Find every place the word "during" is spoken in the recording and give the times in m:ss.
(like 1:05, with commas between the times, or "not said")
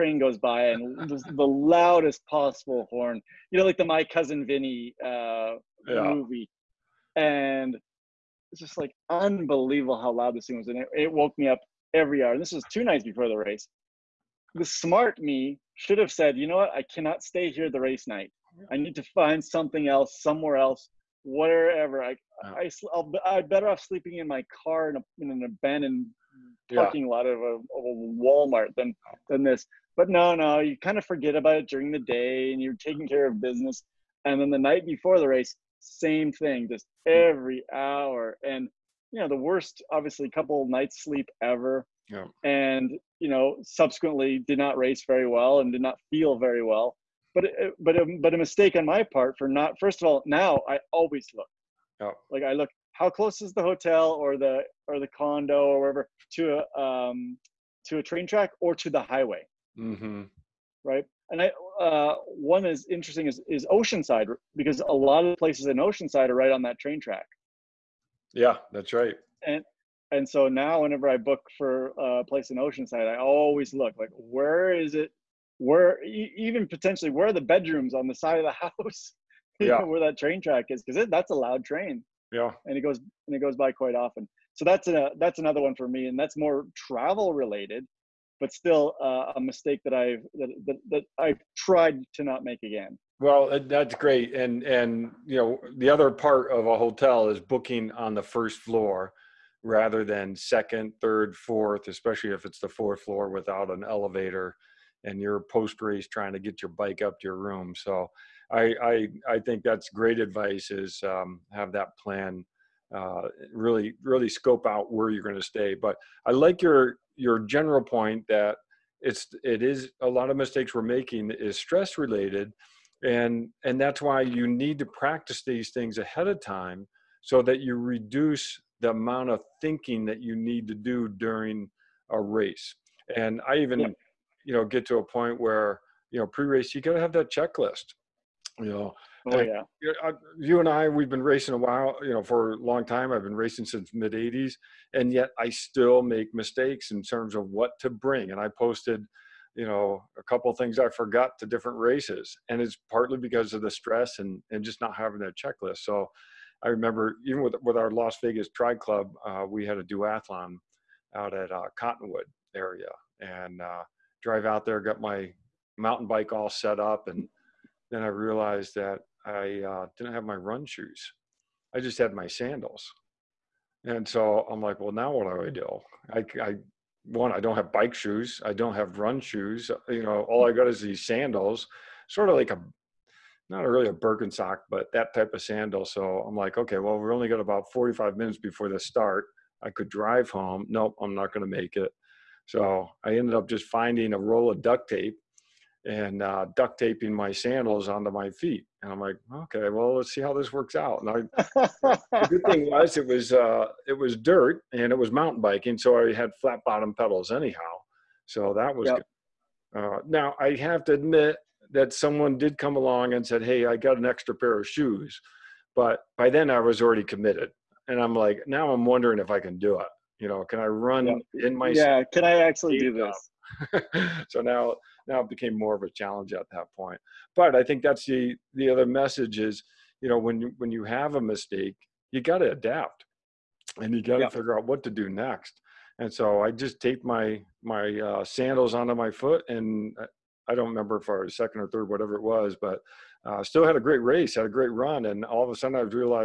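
0:31, 2:11.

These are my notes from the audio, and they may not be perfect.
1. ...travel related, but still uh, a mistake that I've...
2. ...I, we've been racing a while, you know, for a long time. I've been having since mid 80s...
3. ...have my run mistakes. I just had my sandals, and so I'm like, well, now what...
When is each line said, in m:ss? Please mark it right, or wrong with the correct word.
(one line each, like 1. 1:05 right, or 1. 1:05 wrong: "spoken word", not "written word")
1. 1:26 right
2. 2:20 wrong: "racing", not "having"
3. 2:50 wrong: "shoes", not "mistakes".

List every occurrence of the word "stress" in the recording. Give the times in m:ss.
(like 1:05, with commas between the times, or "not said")
2:01, 2:33.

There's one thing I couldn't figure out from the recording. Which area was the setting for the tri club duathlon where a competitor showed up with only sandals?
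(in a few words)
Cottonwood.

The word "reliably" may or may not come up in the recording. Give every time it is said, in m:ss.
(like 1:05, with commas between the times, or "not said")
not said.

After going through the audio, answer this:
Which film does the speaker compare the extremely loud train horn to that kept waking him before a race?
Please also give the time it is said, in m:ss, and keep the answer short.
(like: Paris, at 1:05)
My Cousin Vinny, at 0:03.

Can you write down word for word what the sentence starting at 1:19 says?
where that train track is because that's a loud train.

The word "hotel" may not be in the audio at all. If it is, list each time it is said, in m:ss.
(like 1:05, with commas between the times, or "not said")
0:53, 1:36.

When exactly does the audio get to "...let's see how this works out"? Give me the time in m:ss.
3:19.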